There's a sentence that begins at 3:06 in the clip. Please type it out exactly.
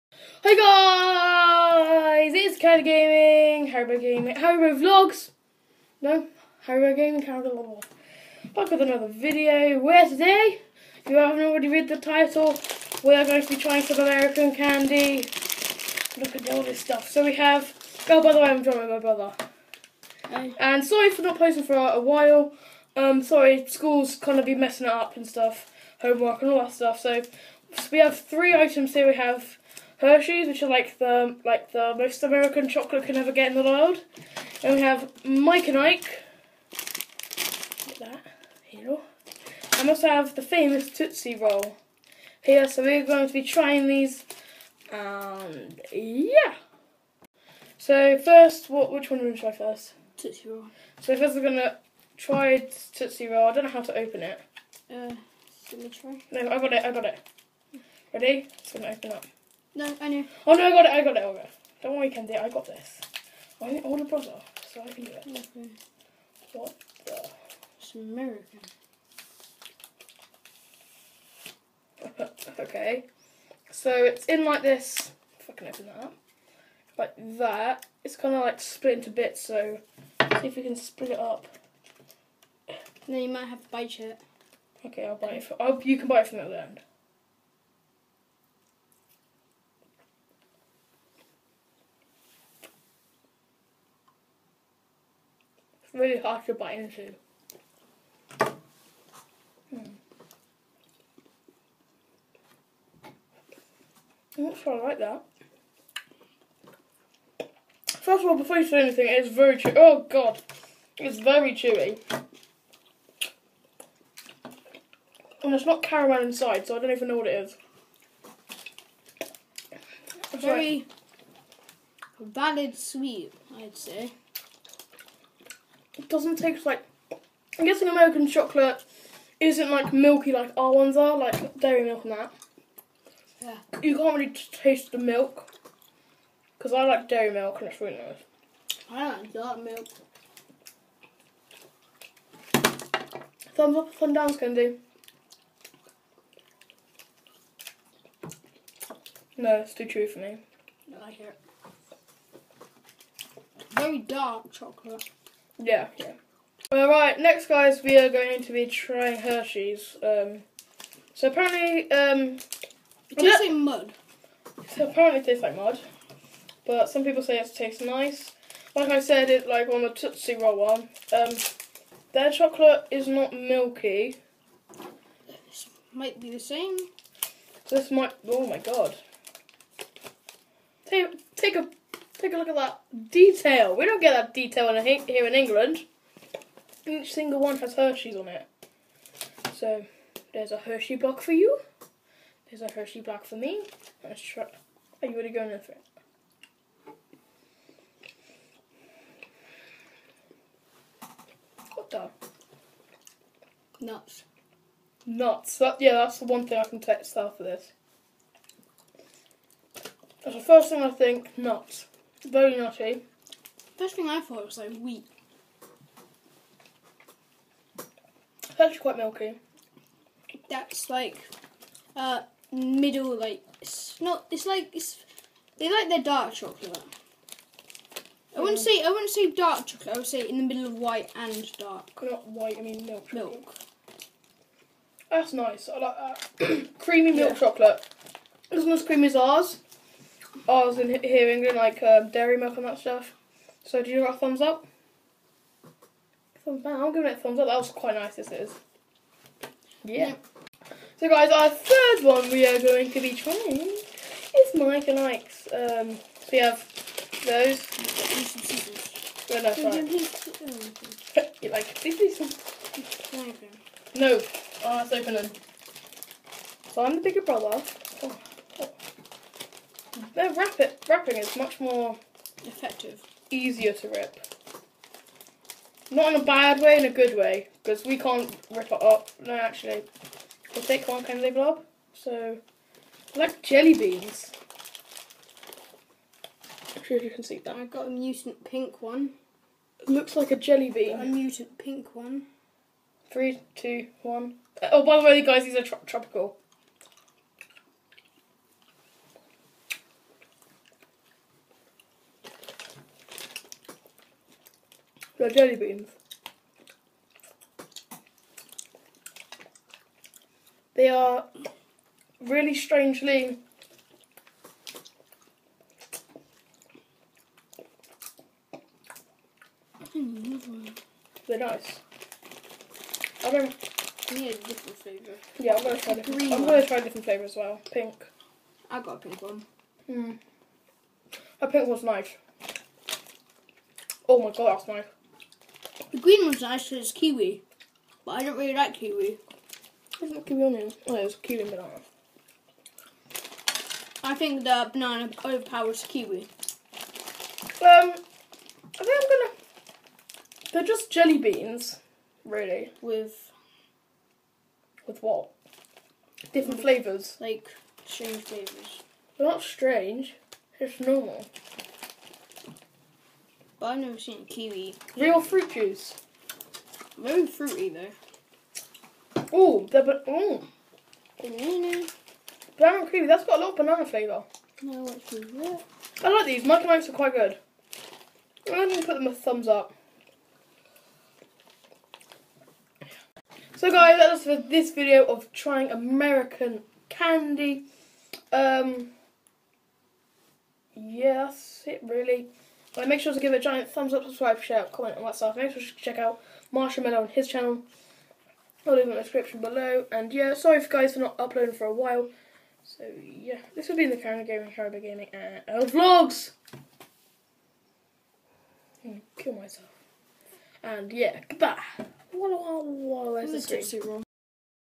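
Each single one has Hershey's on it.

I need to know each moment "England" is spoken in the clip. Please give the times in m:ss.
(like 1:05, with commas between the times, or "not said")
3:05, 4:01.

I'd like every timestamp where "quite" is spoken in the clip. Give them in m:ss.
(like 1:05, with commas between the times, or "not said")
3:38, 4:07, 6:16.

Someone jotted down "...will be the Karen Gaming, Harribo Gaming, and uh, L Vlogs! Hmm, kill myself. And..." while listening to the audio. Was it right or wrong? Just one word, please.
right.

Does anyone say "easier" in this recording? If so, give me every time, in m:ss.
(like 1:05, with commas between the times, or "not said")
4:33.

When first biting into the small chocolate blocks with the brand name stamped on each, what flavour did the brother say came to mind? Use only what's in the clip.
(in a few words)
wheat.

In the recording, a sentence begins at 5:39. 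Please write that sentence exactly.
There's not kiwi on Oh, it's kiwi and banana.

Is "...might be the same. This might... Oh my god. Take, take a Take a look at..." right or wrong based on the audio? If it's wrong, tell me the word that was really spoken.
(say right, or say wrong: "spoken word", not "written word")
right.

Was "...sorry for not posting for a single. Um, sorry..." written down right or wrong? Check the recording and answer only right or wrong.
wrong.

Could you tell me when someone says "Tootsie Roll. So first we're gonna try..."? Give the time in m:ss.
0:50.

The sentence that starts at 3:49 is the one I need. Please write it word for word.
I would say in the middle of white and dark.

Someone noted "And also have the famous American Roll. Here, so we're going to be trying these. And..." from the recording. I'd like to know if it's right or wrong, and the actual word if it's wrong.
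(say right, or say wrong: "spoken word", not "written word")
wrong: "Tootsie", not "American".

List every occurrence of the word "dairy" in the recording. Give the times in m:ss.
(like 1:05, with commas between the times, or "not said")
2:11, 2:17, 4:02.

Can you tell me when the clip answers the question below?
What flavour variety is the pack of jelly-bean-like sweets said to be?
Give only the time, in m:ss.
4:55.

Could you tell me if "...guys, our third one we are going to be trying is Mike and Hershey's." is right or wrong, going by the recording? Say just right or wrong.
wrong.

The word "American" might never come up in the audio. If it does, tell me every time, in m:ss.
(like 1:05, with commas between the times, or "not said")
0:13, 0:32, 1:07, 2:07, 6:25.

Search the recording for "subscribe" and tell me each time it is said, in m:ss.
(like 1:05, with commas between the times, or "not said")
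6:34.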